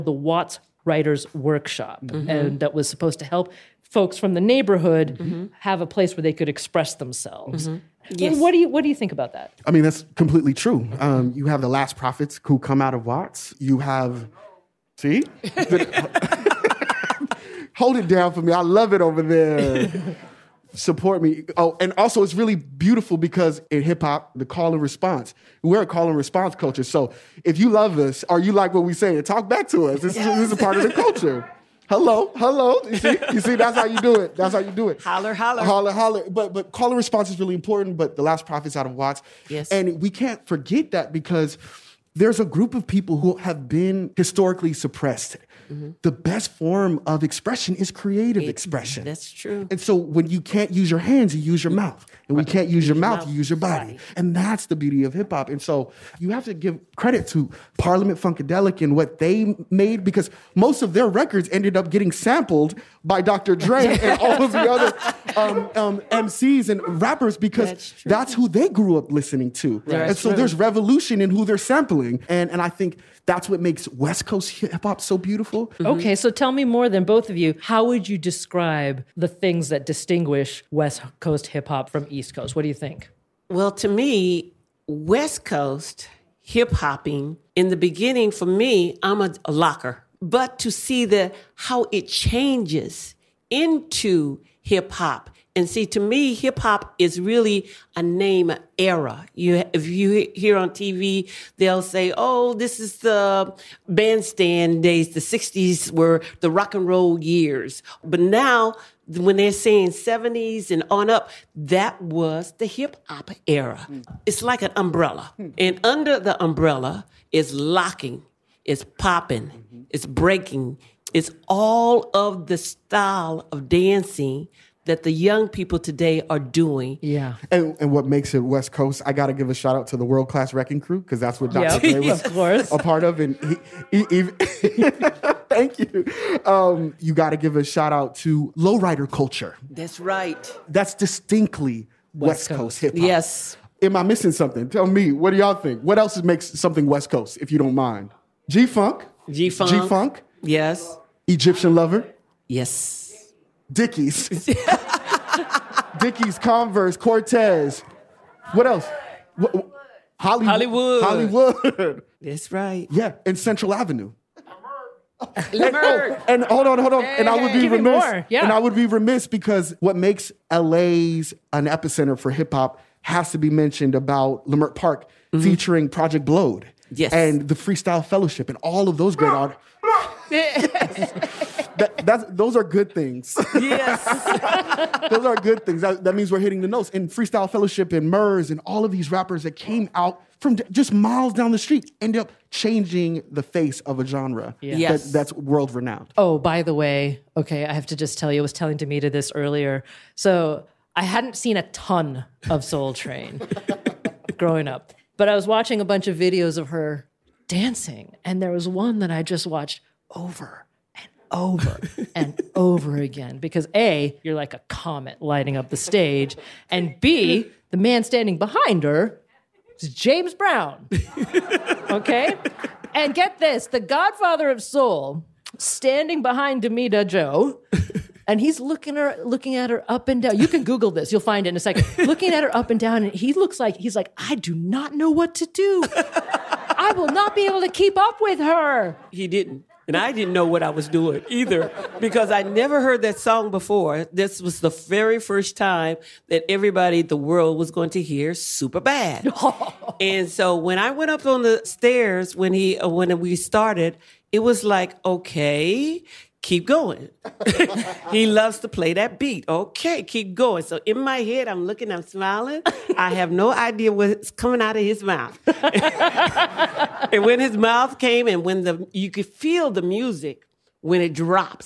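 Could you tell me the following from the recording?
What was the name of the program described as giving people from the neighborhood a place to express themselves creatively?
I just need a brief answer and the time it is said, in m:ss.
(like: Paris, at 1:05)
Watts Writers Workshop, at 0:00.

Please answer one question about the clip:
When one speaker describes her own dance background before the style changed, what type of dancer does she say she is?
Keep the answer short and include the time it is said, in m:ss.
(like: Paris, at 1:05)
A locker, at 1:29.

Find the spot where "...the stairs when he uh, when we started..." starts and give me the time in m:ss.
4:11.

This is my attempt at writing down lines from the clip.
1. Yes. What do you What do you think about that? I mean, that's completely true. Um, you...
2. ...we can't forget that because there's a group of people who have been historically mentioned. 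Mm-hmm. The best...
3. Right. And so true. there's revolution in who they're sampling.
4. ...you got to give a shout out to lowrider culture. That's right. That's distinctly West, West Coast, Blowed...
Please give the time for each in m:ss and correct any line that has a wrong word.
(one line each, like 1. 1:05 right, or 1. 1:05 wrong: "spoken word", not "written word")
1. 0:08 right
2. 0:40 wrong: "suppressed", not "mentioned"
3. 1:09 right
4. 2:17 wrong: "Coast", not "Blowed".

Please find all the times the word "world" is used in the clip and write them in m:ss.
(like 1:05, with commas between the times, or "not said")
2:10, 3:15, 4:07.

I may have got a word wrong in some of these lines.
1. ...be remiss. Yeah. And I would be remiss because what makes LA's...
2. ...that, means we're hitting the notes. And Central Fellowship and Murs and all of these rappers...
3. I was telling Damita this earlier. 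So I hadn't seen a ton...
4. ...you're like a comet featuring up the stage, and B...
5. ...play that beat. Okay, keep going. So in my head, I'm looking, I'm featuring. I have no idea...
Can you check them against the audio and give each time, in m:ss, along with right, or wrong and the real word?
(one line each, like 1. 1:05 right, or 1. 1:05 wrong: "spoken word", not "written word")
1. 2:47 right
2. 3:06 wrong: "Freestyle", not "Central"
3. 3:18 right
4. 3:34 wrong: "lighting", not "featuring"
5. 4:18 wrong: "smiling", not "featuring".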